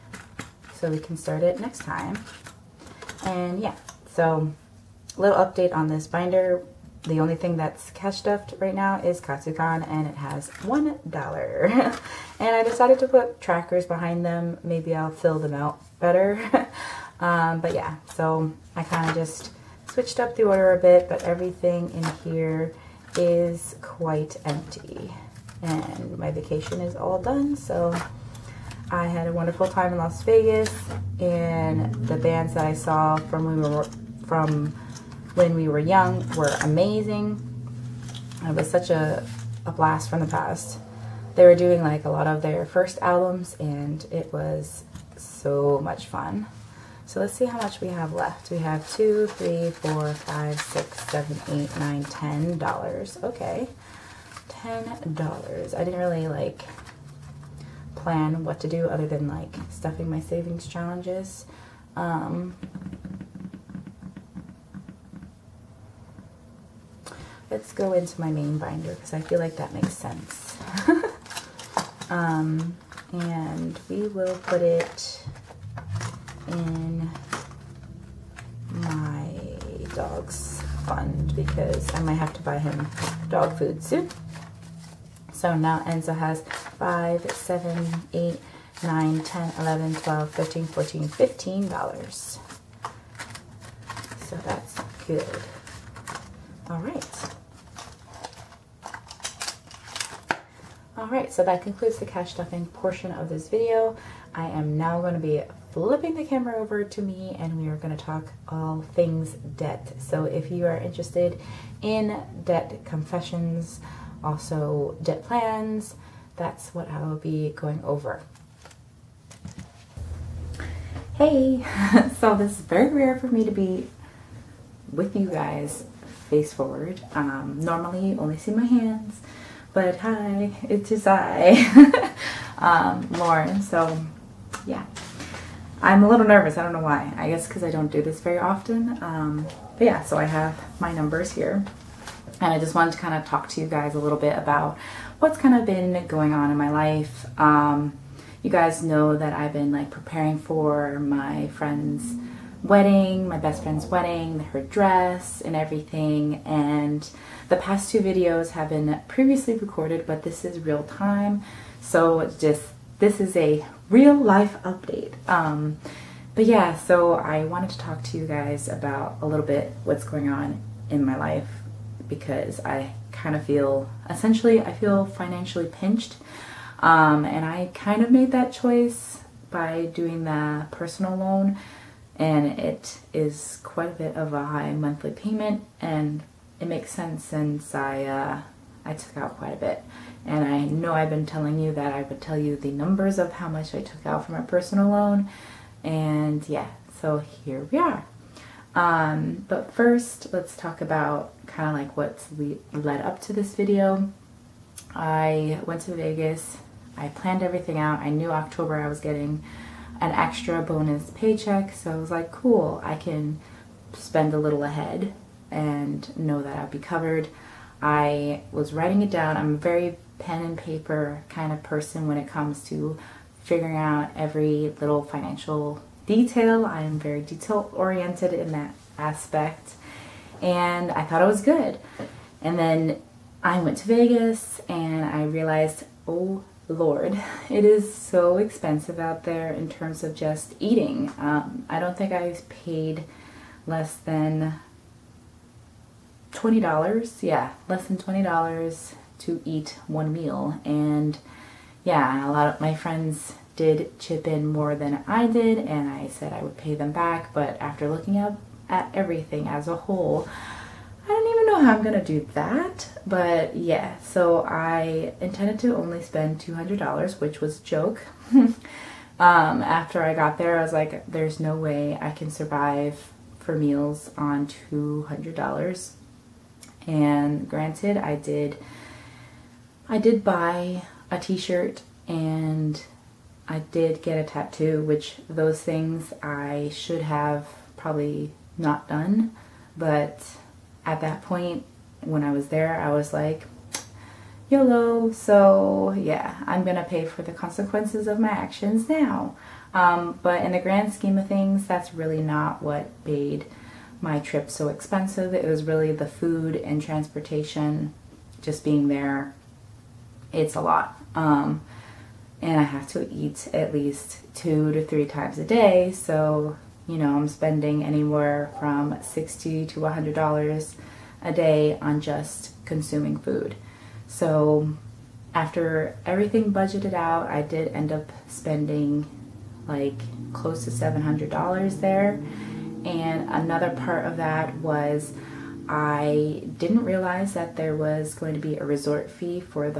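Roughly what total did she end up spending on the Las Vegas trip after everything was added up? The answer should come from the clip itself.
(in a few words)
$700.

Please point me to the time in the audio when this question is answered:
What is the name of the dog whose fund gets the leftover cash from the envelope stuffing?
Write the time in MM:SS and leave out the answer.
01:25.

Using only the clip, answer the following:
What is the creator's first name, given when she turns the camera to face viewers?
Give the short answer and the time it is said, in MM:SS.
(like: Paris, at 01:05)
Lauren, at 02:13.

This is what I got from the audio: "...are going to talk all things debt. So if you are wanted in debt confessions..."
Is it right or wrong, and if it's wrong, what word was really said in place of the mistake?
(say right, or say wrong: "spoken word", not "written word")
wrong: "interested", not "wanted".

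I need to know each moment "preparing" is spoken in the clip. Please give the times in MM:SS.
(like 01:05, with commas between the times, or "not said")
02:29.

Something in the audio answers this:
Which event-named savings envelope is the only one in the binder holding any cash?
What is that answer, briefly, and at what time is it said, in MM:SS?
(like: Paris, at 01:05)
Katsucon, at 00:09.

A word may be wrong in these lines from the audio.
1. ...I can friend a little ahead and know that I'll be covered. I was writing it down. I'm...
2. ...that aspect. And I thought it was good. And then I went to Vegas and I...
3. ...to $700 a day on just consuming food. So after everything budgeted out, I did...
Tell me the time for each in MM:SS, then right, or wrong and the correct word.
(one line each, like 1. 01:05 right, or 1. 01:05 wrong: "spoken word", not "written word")
1. 03:32 wrong: "spend", not "friend"
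2. 03:48 right
3. 05:19 wrong: "100", not "700".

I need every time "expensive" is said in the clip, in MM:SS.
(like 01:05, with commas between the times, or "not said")
03:58, 05:04.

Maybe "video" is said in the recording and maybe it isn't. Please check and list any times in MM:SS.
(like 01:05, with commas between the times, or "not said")
01:43, 02:37, 03:23.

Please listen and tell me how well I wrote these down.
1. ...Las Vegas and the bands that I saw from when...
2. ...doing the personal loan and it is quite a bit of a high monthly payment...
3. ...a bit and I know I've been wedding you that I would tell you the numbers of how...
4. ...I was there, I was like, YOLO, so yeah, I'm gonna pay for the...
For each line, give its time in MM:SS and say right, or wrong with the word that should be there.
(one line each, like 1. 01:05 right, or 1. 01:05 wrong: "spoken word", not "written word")
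1. 00:29 right
2. 02:59 right
3. 03:09 wrong: "telling", not "wedding"
4. 04:52 right.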